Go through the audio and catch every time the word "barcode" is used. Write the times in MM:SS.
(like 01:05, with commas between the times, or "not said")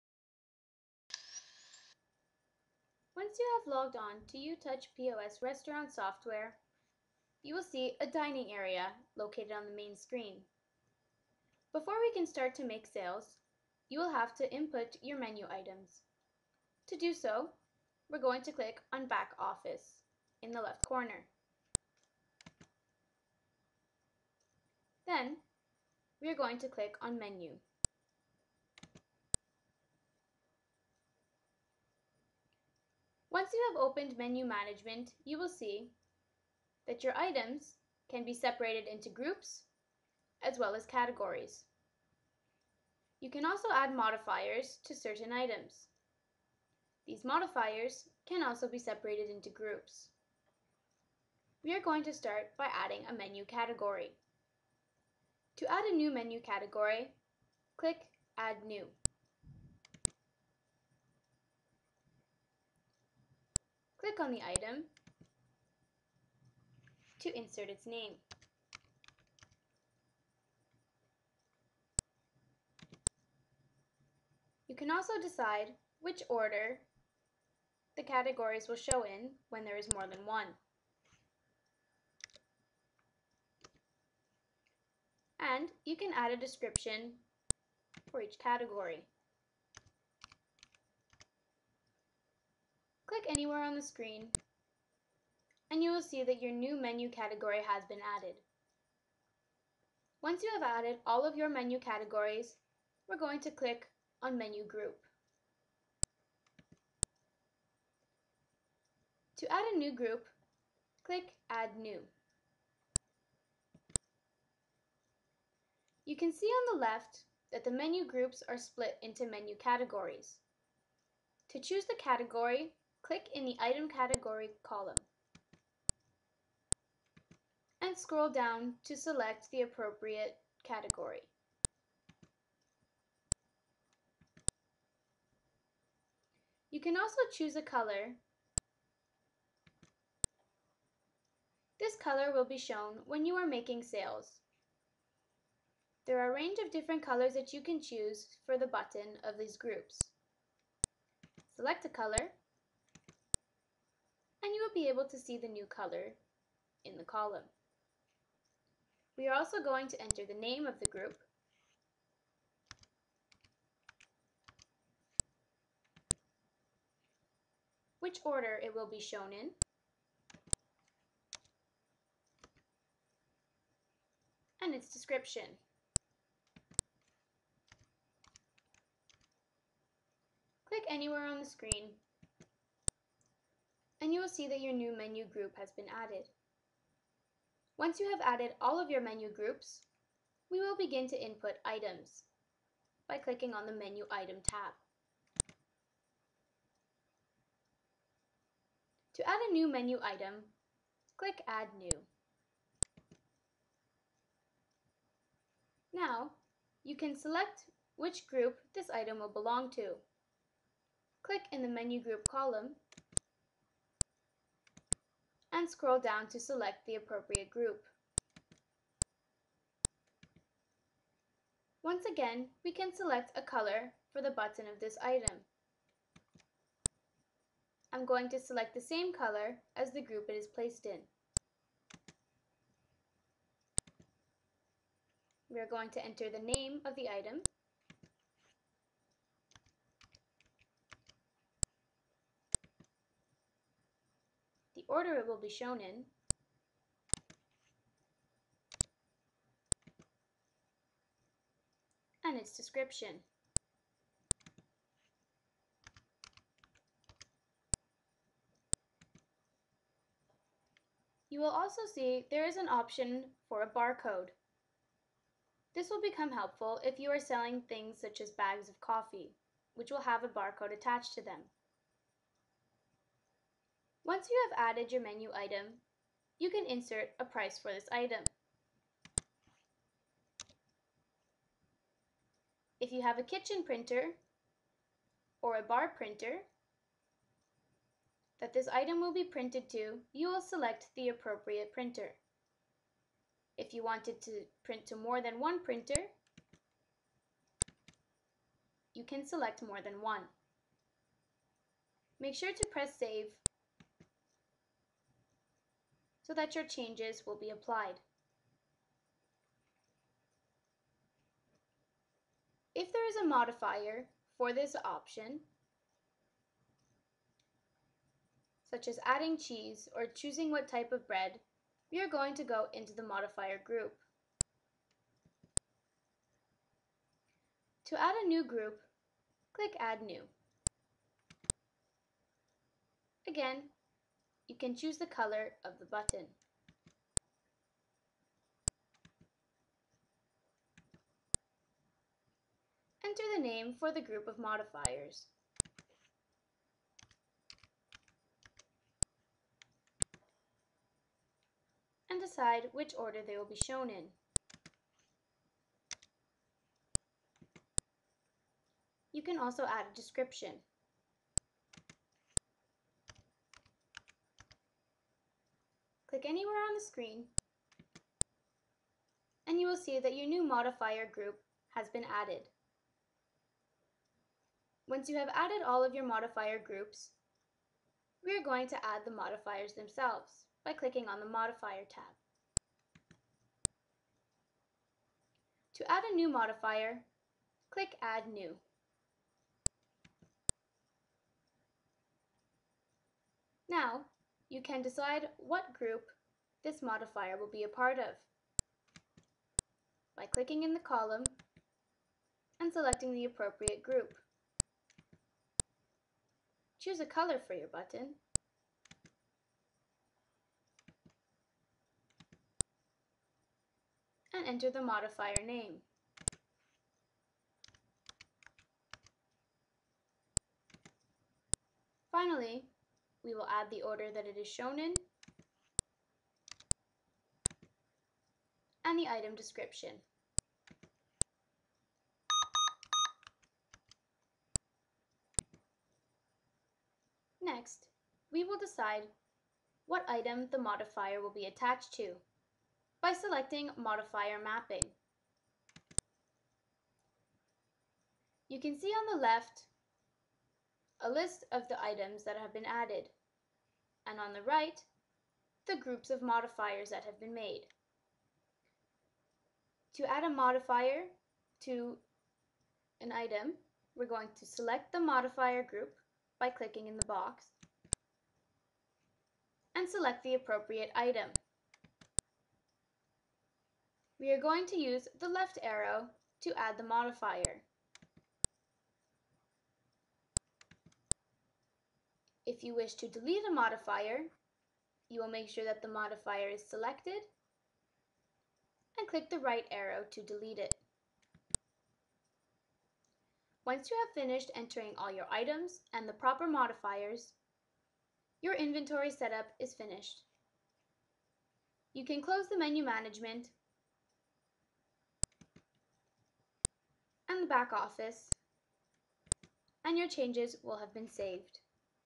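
04:23, 04:30.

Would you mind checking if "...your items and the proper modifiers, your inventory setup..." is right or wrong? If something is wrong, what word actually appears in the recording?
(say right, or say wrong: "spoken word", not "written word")
right.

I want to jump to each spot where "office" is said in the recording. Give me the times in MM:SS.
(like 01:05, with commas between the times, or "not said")
00:19, 08:27.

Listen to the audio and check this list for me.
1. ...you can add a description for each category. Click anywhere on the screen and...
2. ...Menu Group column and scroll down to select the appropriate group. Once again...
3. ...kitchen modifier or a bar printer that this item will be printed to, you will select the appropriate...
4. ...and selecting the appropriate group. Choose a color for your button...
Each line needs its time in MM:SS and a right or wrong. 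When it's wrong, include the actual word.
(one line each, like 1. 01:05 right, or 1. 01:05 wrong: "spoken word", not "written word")
1. 01:25 right
2. 03:31 right
3. 04:43 wrong: "printer", not "modifier"
4. 06:42 right.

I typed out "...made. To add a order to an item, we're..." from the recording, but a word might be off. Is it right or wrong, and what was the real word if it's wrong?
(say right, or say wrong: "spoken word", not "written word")
wrong: "modifier", not "order".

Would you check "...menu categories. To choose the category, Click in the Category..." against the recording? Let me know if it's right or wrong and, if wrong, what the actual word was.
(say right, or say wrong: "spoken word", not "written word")
wrong: "Item", not "Category".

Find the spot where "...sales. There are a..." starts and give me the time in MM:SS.
02:23.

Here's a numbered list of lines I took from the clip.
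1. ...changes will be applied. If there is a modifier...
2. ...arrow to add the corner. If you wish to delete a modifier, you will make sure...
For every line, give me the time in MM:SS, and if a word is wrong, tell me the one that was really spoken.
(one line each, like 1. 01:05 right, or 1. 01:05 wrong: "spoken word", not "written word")
1. 05:06 right
2. 07:55 wrong: "modifier", not "corner".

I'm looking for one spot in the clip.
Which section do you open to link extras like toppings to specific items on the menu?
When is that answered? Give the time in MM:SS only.
07:23.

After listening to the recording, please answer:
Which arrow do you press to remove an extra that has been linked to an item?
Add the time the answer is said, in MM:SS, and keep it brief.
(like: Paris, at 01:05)
right arrow, at 08:09.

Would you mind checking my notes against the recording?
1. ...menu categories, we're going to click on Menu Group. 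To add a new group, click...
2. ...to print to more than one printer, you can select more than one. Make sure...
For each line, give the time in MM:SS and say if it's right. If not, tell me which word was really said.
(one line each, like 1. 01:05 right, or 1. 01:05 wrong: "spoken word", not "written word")
1. 01:41 right
2. 04:54 right.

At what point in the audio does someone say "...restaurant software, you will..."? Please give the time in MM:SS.
00:05.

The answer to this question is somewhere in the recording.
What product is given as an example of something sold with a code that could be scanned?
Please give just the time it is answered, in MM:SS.
04:28.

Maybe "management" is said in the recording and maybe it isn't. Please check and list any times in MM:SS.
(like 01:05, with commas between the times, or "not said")
00:34, 08:22.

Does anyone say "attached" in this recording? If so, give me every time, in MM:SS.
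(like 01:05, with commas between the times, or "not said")
04:30, 07:21.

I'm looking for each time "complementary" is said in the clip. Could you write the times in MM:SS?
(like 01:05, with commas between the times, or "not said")
not said.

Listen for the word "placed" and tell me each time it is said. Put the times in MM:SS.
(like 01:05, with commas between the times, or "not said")
03:50.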